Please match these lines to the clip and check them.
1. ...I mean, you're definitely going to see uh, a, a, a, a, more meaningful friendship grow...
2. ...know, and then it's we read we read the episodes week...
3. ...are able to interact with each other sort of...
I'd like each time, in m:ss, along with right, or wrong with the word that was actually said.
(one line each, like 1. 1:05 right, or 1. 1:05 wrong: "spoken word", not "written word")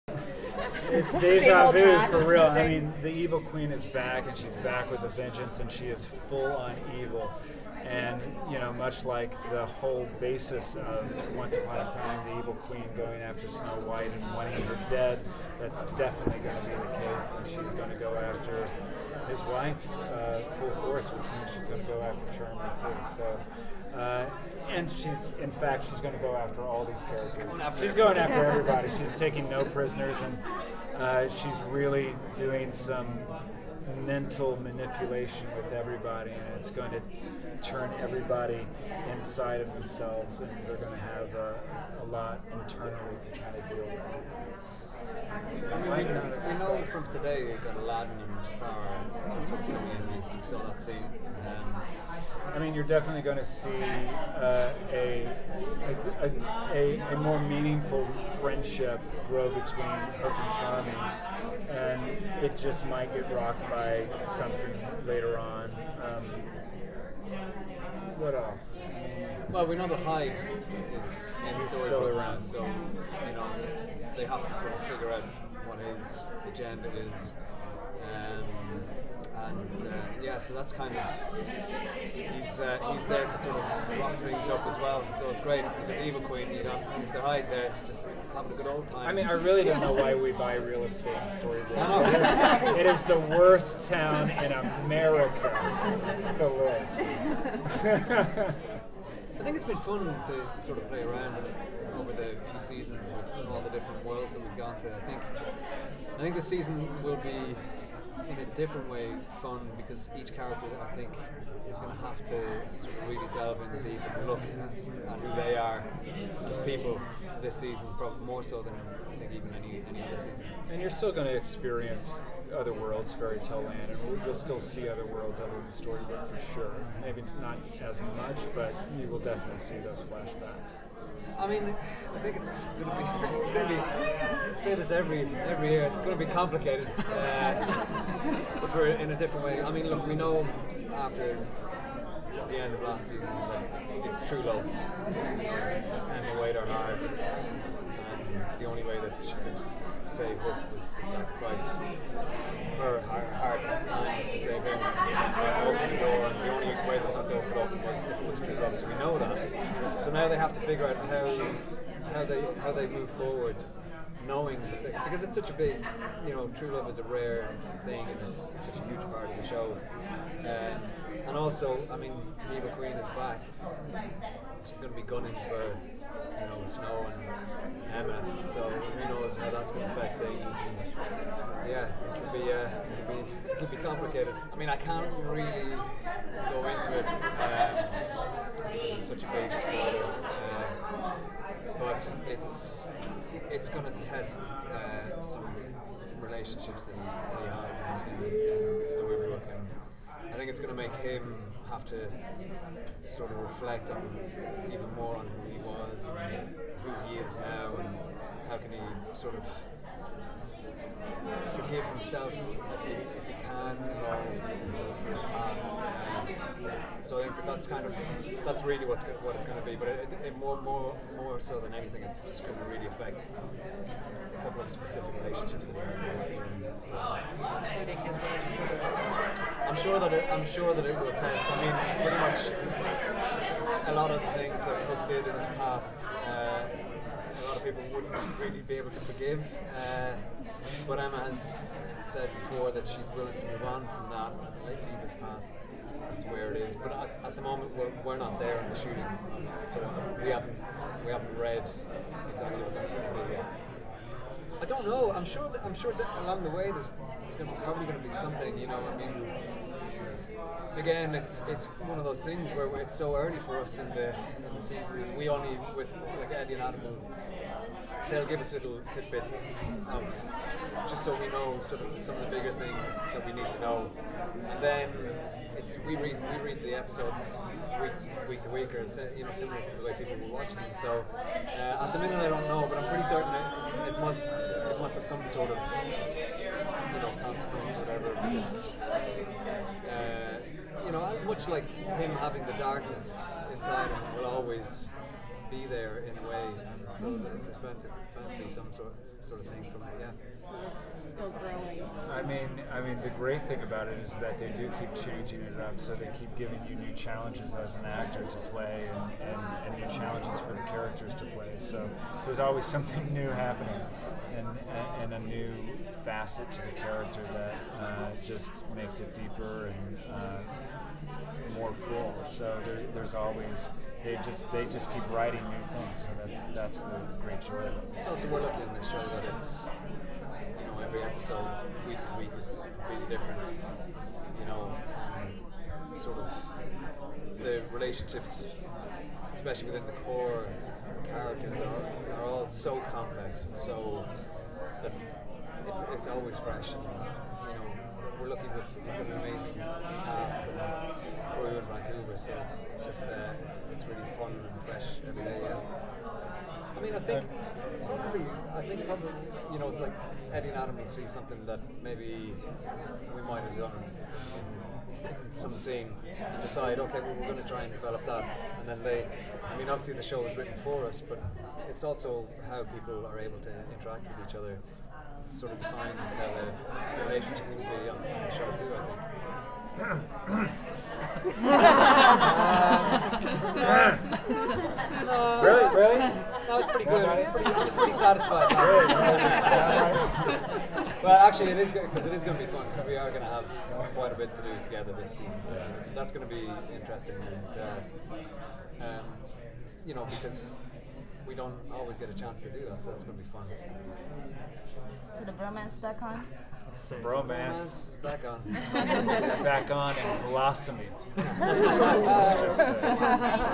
1. 0:52 right
2. 4:33 right
3. 6:13 right.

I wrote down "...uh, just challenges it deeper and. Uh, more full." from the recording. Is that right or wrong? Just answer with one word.
wrong.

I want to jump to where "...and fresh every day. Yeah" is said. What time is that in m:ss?
5:54.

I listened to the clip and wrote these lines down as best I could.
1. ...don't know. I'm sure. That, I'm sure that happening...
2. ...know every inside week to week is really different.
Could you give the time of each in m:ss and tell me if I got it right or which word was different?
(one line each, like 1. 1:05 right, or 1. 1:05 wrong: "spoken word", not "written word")
1. 4:14 wrong: "along", not "happening"
2. 5:30 wrong: "episode", not "inside".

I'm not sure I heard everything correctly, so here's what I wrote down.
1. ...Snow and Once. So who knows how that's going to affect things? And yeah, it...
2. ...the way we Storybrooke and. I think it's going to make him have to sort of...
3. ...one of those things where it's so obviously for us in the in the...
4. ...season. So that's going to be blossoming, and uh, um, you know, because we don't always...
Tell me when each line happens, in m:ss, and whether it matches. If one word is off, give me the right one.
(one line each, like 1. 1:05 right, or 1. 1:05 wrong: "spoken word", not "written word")
1. 2:56 wrong: "Emma", not "Once"
2. 3:18 right
3. 4:21 wrong: "early", not "obviously"
4. 6:35 wrong: "interesting", not "blossoming".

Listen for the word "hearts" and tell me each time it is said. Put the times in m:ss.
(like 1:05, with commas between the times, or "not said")
2:26, 2:33.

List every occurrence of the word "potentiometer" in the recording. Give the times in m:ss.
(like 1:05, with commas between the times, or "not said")
not said.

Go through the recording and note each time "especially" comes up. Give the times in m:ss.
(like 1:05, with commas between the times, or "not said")
5:39.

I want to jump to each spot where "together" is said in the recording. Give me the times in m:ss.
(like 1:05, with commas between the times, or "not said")
6:34.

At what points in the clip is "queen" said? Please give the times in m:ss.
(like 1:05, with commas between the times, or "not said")
0:03, 0:12, 1:26, 2:52.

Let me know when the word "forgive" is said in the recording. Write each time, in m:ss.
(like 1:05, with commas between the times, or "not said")
3:31, 3:59.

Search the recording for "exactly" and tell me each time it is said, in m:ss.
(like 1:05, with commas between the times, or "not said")
4:12.